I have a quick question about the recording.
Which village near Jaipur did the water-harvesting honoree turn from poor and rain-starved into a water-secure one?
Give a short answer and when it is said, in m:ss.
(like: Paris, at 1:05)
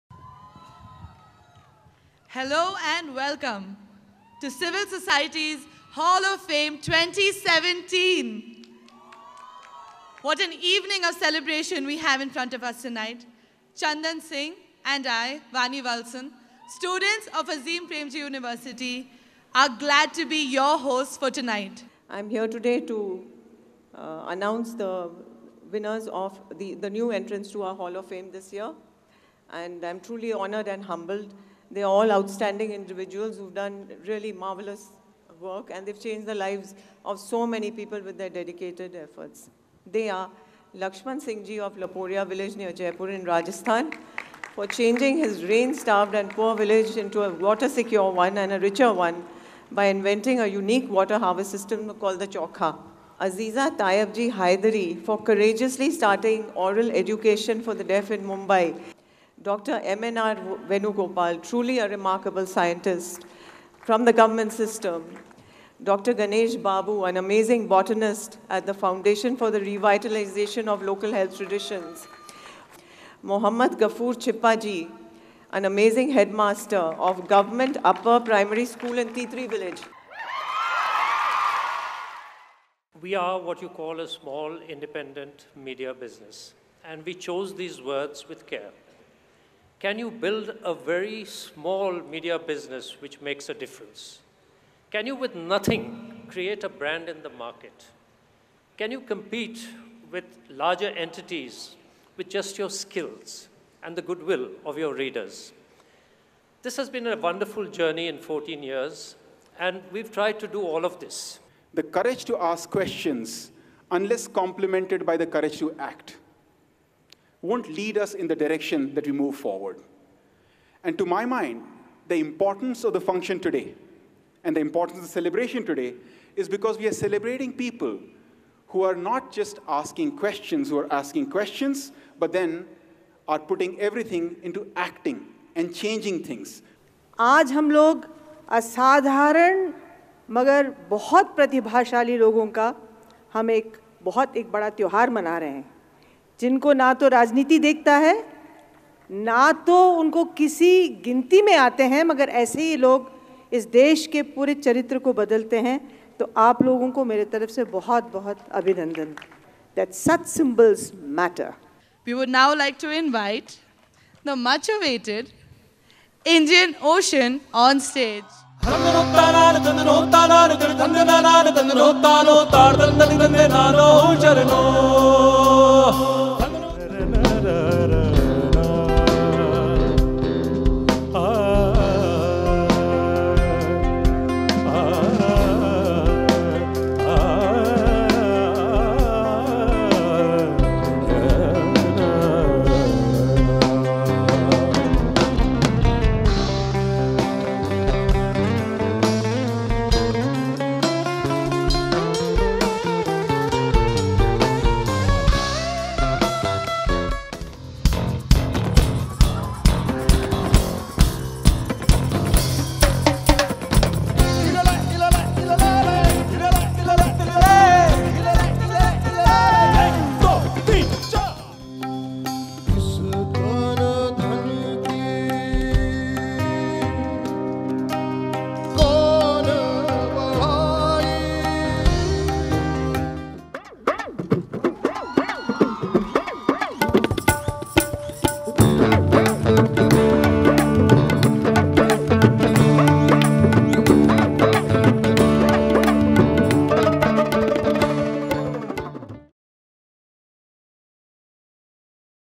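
Laporia, at 0:41.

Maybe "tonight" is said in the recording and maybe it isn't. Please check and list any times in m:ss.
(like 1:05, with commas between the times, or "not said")
0:12, 0:21.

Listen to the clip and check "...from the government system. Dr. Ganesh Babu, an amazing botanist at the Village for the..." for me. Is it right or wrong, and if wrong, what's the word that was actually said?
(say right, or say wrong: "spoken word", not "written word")
wrong: "Foundation", not "Village".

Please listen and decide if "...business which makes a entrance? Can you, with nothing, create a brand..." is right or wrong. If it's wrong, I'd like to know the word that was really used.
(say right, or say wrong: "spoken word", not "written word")
wrong: "difference", not "entrance".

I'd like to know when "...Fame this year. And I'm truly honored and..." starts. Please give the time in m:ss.
0:28.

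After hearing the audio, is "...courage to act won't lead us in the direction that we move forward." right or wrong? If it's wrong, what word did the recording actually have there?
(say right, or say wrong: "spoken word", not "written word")
right.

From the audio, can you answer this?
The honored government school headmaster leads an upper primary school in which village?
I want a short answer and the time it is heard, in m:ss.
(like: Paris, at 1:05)
Titri, at 1:19.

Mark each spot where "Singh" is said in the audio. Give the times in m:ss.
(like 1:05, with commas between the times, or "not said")
0:14, 0:41.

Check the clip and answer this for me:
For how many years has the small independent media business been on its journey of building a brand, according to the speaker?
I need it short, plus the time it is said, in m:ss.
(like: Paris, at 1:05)
14, at 1:48.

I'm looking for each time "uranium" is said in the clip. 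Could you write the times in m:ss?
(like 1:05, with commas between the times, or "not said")
not said.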